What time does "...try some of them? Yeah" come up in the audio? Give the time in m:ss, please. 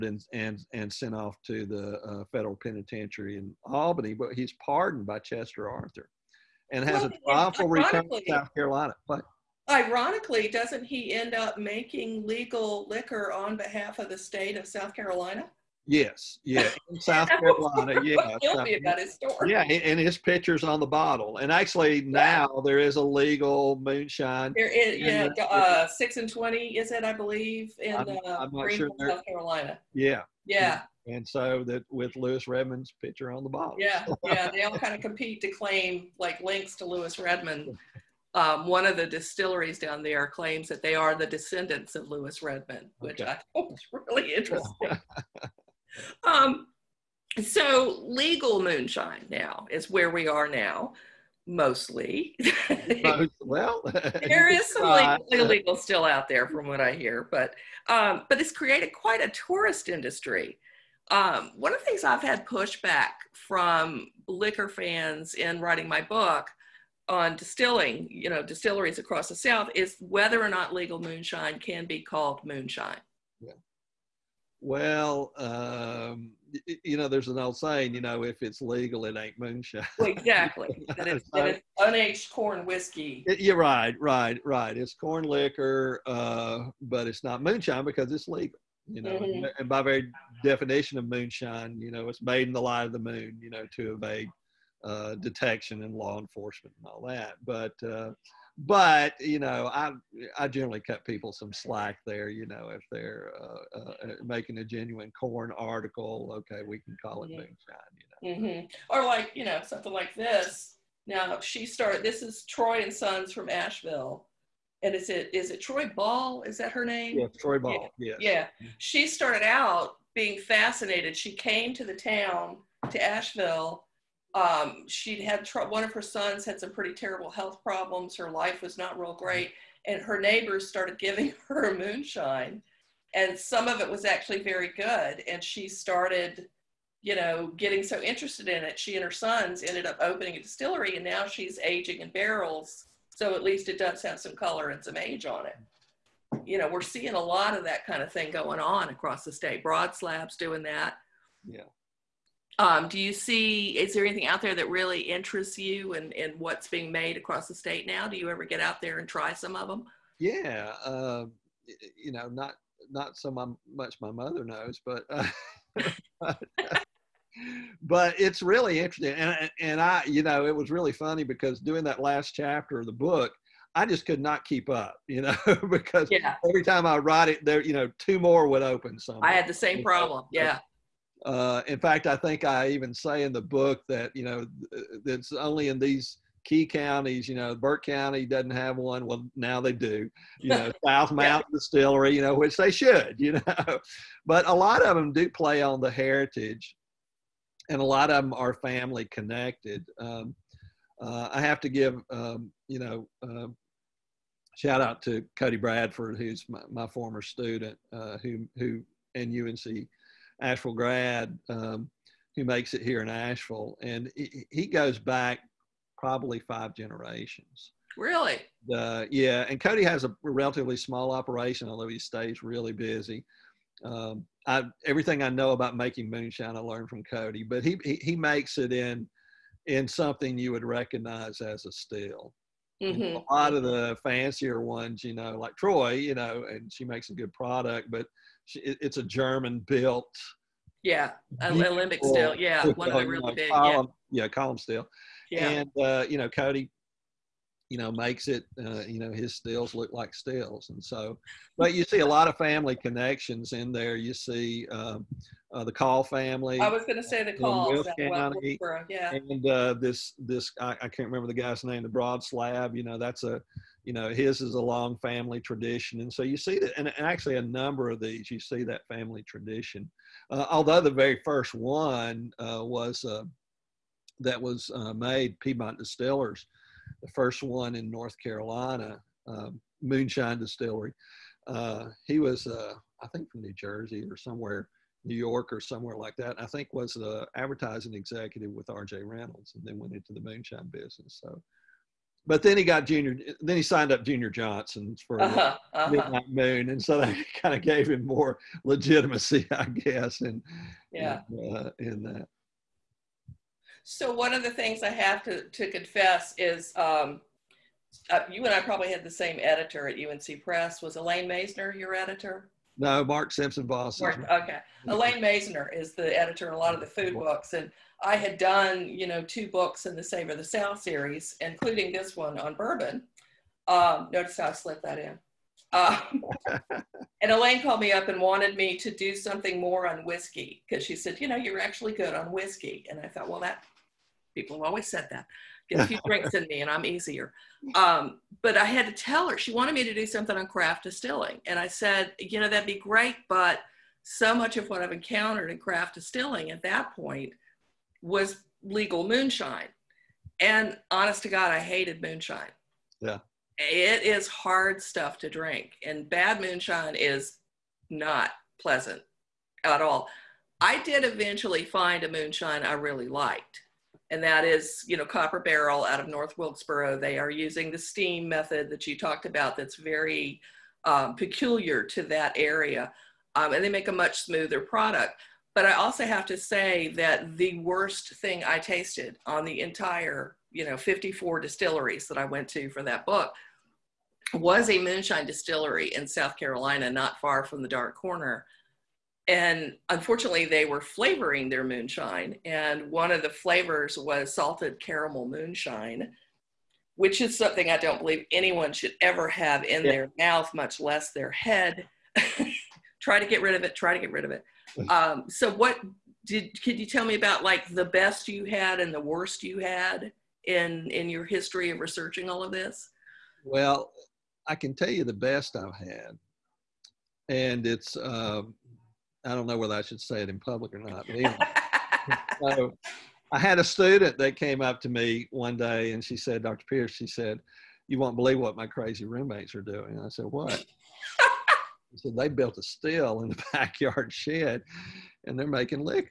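2:39.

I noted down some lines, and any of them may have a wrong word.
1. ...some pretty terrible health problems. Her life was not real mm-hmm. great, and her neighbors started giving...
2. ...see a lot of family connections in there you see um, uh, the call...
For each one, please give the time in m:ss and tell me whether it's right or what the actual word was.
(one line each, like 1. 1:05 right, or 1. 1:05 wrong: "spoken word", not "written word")
1. 2:06 right
2. 4:11 right.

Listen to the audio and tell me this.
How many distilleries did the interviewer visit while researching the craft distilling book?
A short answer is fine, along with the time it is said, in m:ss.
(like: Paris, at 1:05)
54, at 6:20.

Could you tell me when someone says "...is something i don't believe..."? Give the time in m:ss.
6:37.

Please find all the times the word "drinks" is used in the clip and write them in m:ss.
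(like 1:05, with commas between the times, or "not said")
5:36, 5:55.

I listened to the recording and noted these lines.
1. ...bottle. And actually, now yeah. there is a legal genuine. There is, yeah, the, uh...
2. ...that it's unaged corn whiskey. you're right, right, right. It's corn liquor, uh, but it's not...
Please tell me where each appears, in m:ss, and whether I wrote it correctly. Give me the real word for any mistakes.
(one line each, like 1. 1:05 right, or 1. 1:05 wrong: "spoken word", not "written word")
1. 0:20 wrong: "moonshine", not "genuine"
2. 1:21 right.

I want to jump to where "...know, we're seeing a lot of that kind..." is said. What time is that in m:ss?
2:26.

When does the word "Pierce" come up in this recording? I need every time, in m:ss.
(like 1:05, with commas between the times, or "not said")
7:06.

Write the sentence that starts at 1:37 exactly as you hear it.
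But uh, but you know, I I generally cut people some slack there.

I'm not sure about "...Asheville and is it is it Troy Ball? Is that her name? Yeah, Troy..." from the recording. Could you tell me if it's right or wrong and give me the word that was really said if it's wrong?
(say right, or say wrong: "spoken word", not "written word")
right.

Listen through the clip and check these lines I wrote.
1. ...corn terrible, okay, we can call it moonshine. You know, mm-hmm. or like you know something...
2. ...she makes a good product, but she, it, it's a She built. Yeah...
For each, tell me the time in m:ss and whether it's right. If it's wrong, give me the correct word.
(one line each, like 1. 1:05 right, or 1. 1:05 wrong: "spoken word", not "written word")
1. 1:45 wrong: "article", not "terrible"
2. 3:56 wrong: "German", not "She".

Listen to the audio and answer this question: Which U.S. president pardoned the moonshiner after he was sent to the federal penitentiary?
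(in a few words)
Chester Arthur.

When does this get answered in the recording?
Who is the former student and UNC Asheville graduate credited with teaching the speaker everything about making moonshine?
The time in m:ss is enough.
3:25.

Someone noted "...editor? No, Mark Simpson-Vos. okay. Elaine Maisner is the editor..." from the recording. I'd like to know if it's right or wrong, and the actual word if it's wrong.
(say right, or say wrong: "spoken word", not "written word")
right.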